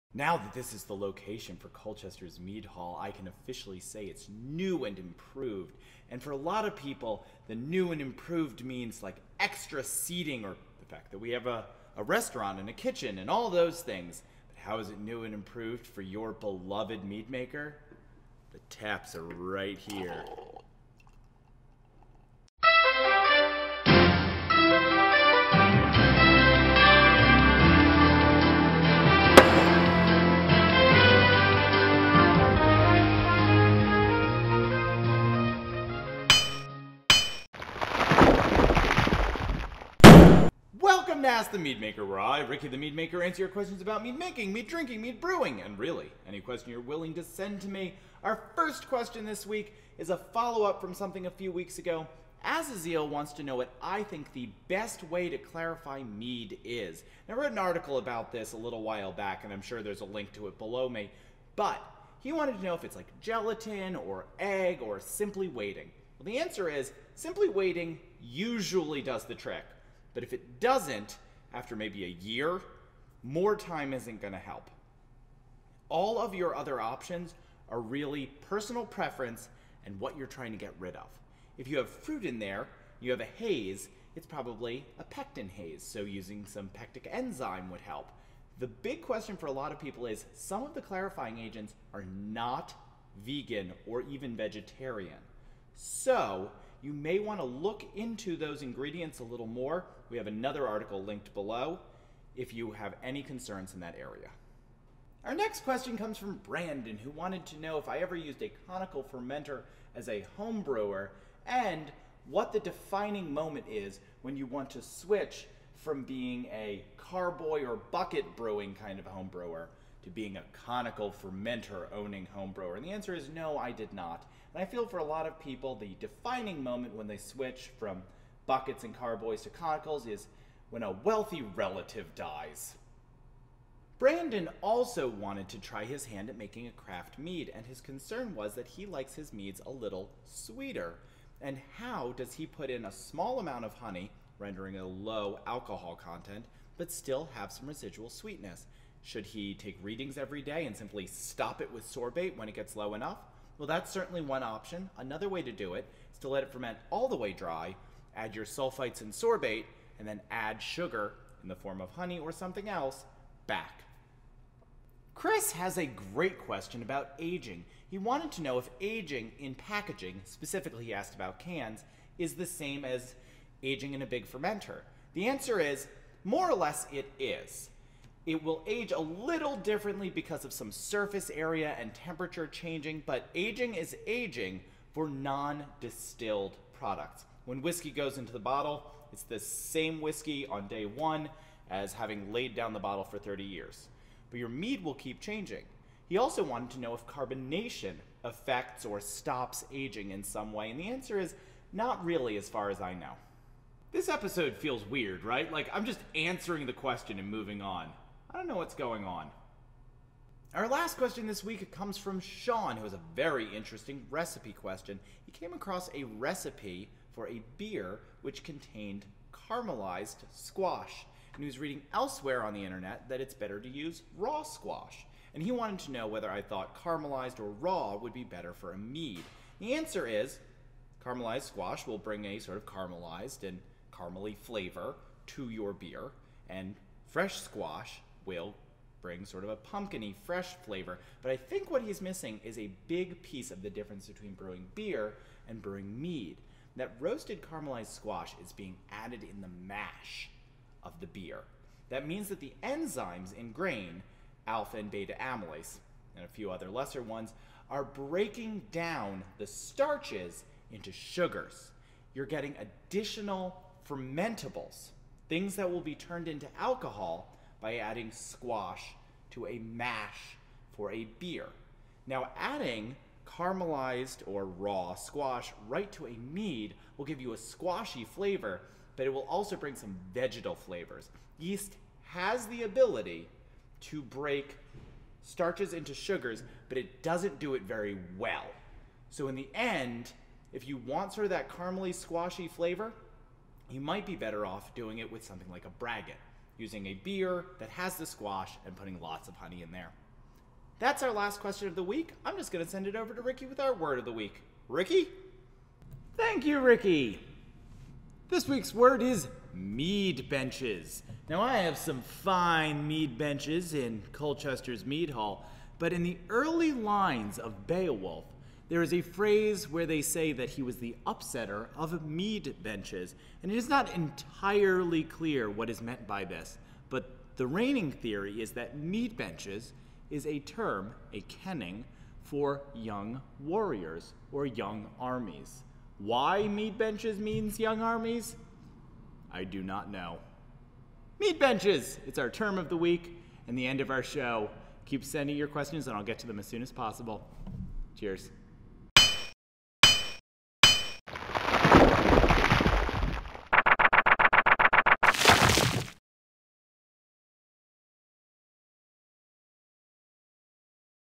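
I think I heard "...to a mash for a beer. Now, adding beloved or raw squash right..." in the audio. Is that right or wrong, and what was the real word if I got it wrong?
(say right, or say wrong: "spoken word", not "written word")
wrong: "caramelized", not "beloved".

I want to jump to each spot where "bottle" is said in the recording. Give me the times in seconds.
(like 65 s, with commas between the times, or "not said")
188 s, 192 s.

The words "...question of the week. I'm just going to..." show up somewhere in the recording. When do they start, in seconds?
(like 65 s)
301 s.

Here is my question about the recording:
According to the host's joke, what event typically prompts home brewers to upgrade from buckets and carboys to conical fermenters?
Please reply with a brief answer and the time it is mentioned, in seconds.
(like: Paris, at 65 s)
A wealthy relative dies, at 130 s.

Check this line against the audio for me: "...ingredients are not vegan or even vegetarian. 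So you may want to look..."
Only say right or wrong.
wrong.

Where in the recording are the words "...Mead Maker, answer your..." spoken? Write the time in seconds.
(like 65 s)
42 s.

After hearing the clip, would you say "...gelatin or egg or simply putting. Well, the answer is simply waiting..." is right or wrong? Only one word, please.
wrong.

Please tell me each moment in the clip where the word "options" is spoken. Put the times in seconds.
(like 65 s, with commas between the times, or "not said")
76 s, 154 s.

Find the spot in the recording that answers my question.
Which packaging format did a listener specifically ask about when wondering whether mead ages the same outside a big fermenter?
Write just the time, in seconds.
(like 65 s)
171 s.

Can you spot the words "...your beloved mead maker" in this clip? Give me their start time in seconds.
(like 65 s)
16 s.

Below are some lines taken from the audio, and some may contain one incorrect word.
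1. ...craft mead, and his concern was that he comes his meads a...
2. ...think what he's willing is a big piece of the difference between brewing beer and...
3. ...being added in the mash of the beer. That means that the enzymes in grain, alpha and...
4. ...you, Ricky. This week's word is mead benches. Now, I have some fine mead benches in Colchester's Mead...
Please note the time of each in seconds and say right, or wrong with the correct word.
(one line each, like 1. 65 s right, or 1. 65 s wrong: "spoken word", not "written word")
1. 136 s wrong: "likes", not "comes"
2. 241 s wrong: "missing", not "willing"
3. 248 s right
4. 306 s right.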